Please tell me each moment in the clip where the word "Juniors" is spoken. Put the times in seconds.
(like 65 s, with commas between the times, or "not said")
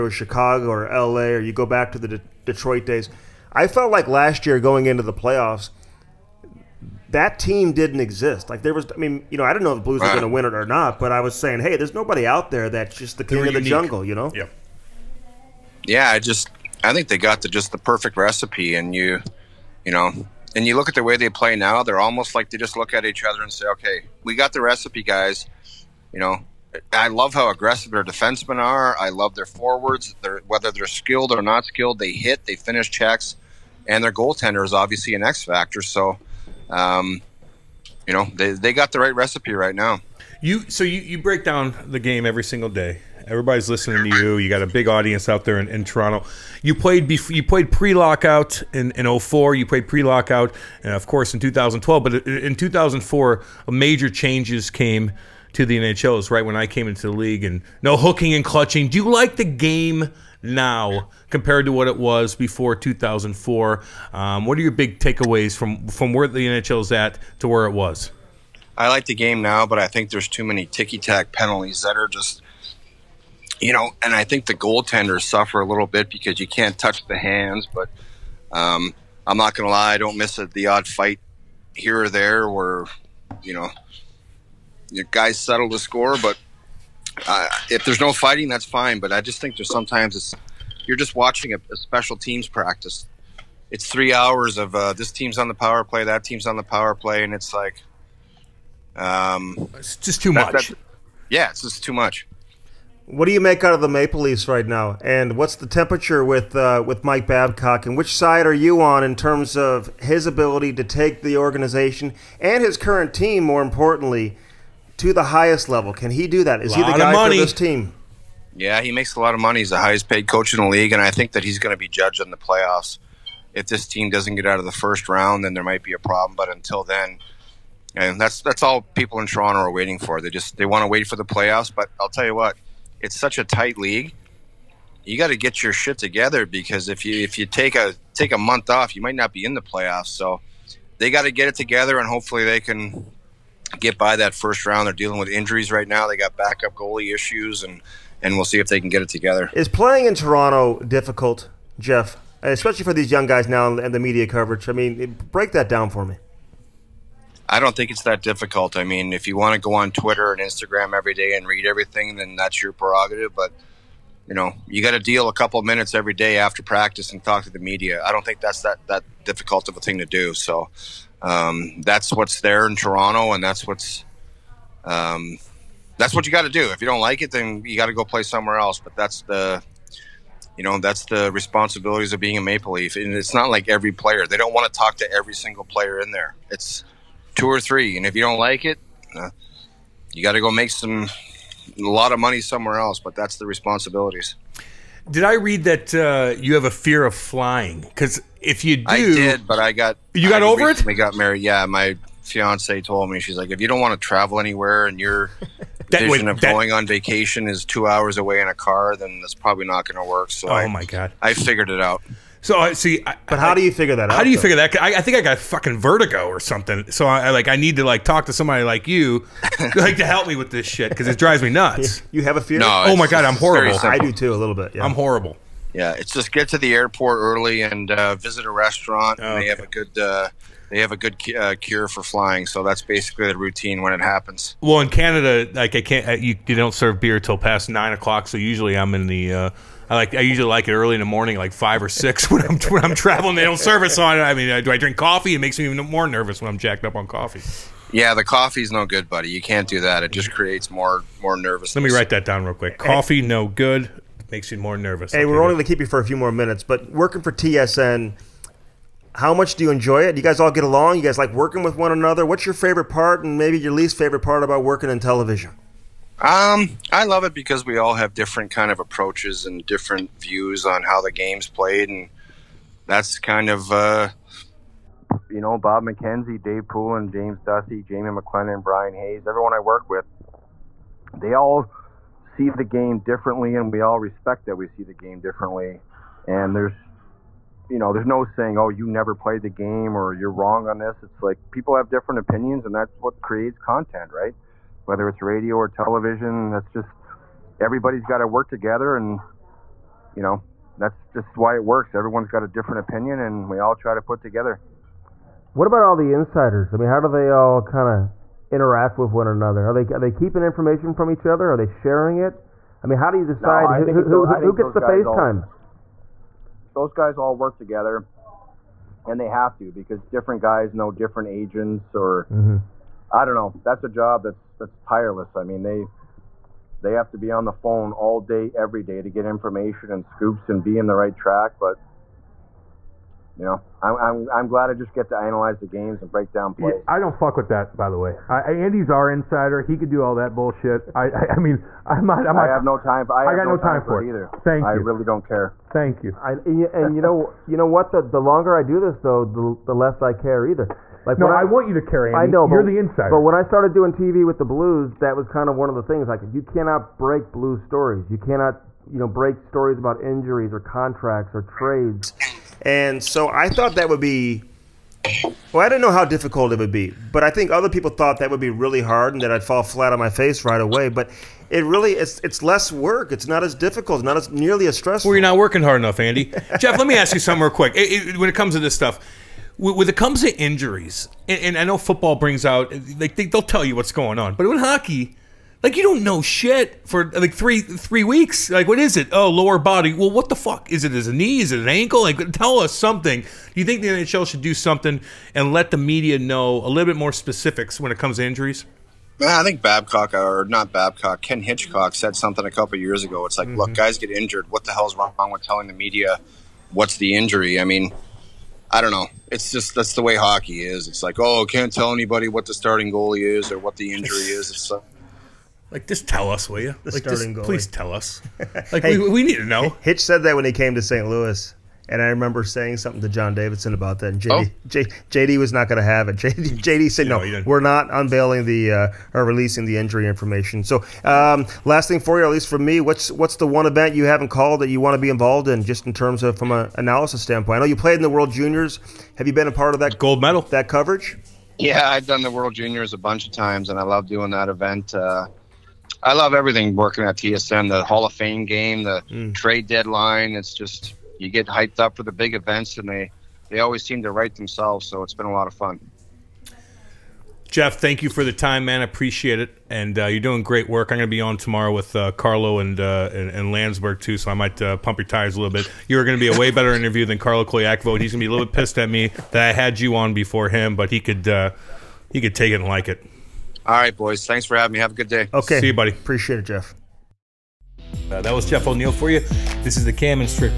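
438 s, 442 s.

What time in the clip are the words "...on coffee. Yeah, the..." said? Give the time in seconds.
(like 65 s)
246 s.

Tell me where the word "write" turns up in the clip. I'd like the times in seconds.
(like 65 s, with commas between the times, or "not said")
251 s, 454 s.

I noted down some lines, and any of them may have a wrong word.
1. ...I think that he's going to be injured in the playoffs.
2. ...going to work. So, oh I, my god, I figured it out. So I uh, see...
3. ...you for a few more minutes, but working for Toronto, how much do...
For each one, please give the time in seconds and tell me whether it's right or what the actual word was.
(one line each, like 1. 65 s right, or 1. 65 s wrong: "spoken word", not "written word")
1. 121 s wrong: "judged", not "injured"
2. 209 s right
3. 255 s wrong: "TSN", not "Toronto".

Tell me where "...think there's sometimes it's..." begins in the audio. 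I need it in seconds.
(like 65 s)
89 s.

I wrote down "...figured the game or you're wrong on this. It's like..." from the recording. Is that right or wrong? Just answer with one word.
wrong.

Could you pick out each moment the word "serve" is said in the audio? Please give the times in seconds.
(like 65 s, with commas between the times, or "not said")
236 s, 243 s.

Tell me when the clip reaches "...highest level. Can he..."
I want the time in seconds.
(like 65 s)
115 s.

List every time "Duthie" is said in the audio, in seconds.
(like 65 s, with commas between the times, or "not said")
277 s.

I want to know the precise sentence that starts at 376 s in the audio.
Jeff, let me ask you something real quick.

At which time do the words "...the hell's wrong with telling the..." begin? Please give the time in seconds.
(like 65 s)
404 s.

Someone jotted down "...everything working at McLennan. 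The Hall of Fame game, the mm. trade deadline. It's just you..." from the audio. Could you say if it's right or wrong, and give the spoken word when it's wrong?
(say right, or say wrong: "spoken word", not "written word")
wrong: "TSN", not "McLennan".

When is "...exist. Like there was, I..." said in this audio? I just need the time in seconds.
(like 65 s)
7 s.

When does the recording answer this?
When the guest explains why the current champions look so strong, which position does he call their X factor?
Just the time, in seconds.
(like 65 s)
34 s.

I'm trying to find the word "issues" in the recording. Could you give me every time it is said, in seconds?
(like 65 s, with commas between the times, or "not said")
147 s.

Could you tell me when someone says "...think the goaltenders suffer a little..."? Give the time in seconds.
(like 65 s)
74 s.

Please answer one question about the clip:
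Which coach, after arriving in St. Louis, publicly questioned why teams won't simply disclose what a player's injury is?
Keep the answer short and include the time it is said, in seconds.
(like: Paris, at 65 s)
Ken Hitchcock, at 401 s.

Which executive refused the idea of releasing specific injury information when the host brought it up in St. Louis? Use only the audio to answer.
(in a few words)
John Davidson.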